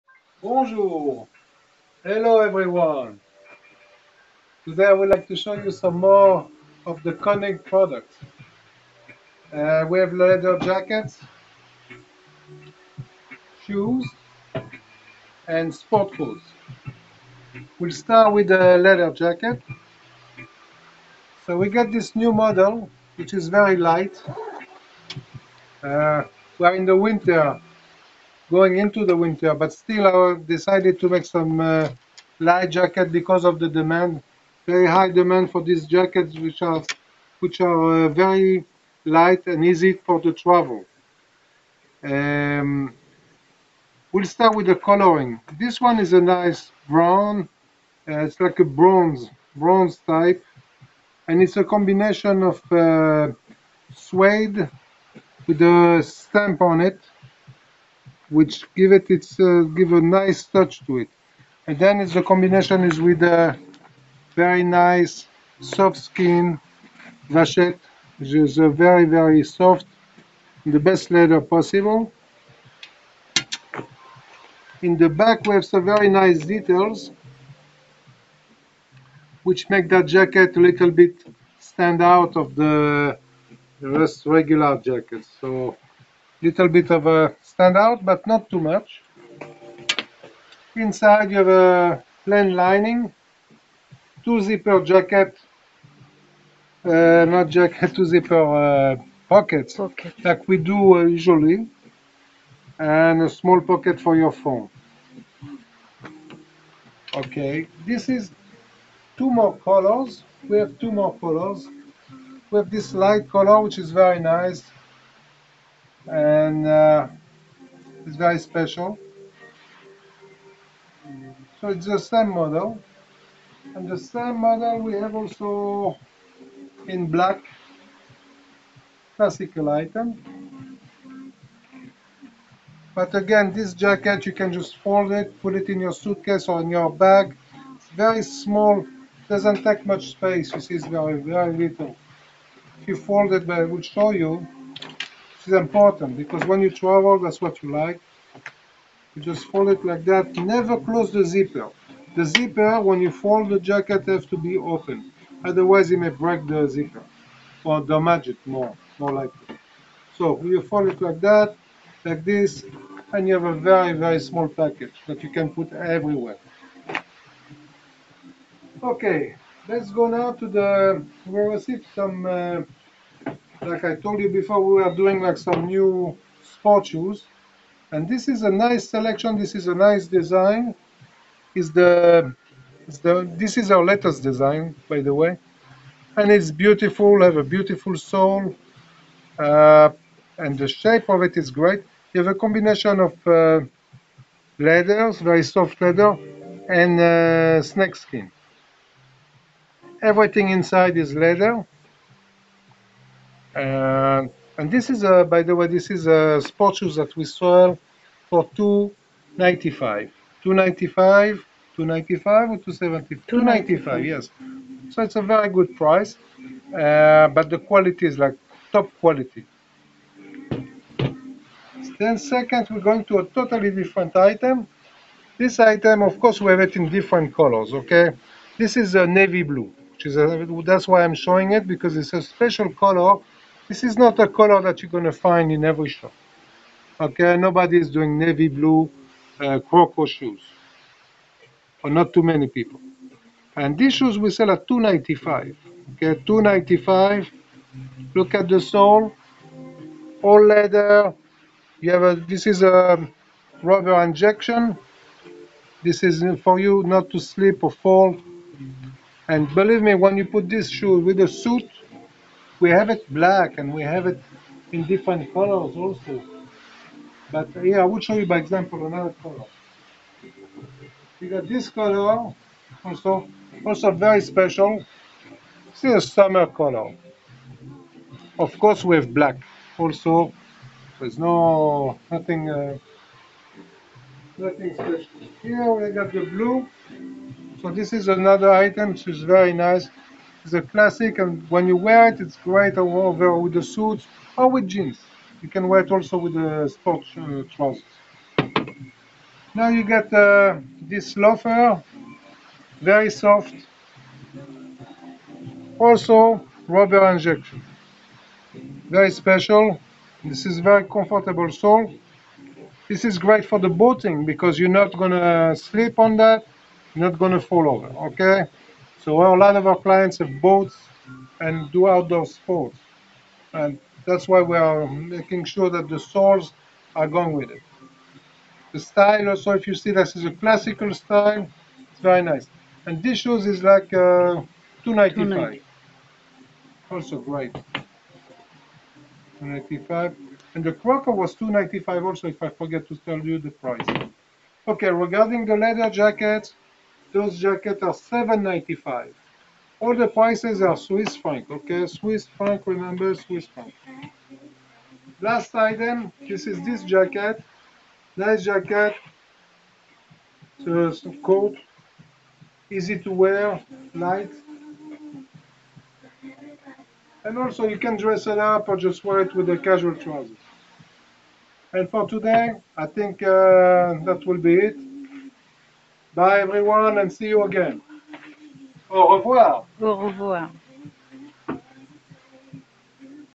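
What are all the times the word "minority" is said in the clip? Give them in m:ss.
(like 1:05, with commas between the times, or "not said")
not said.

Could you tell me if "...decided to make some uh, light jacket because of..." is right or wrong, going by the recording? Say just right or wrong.
right.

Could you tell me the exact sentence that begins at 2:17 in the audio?
It's very small, doesn't take much space.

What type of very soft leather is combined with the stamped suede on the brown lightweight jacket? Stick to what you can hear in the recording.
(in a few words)
vachette.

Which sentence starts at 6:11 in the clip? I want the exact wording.
And for today, I think uh, that will be it.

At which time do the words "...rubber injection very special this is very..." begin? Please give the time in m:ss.
5:06.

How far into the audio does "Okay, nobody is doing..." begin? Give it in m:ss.
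3:56.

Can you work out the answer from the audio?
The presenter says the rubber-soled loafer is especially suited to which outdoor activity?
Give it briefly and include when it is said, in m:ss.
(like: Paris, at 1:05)
boating, at 5:13.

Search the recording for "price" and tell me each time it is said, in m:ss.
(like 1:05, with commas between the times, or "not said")
3:35, 5:43, 5:50.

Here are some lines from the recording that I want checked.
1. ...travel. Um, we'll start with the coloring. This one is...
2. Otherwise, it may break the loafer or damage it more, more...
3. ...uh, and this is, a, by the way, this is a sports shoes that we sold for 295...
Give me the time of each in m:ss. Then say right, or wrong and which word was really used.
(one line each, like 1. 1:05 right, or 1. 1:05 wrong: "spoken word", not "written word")
1. 0:40 right
2. 2:35 wrong: "zipper", not "loafer"
3. 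3:23 right.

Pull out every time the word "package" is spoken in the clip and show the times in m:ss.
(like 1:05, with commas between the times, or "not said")
2:44.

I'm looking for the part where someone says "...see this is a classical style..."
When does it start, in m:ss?
5:29.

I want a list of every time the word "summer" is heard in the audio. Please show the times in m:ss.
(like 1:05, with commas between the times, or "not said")
4:36.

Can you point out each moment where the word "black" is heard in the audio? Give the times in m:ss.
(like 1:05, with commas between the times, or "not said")
2:07, 4:23, 4:39.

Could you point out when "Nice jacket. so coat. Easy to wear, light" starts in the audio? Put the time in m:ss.
5:58.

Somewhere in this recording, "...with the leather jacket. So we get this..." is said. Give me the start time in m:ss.
0:18.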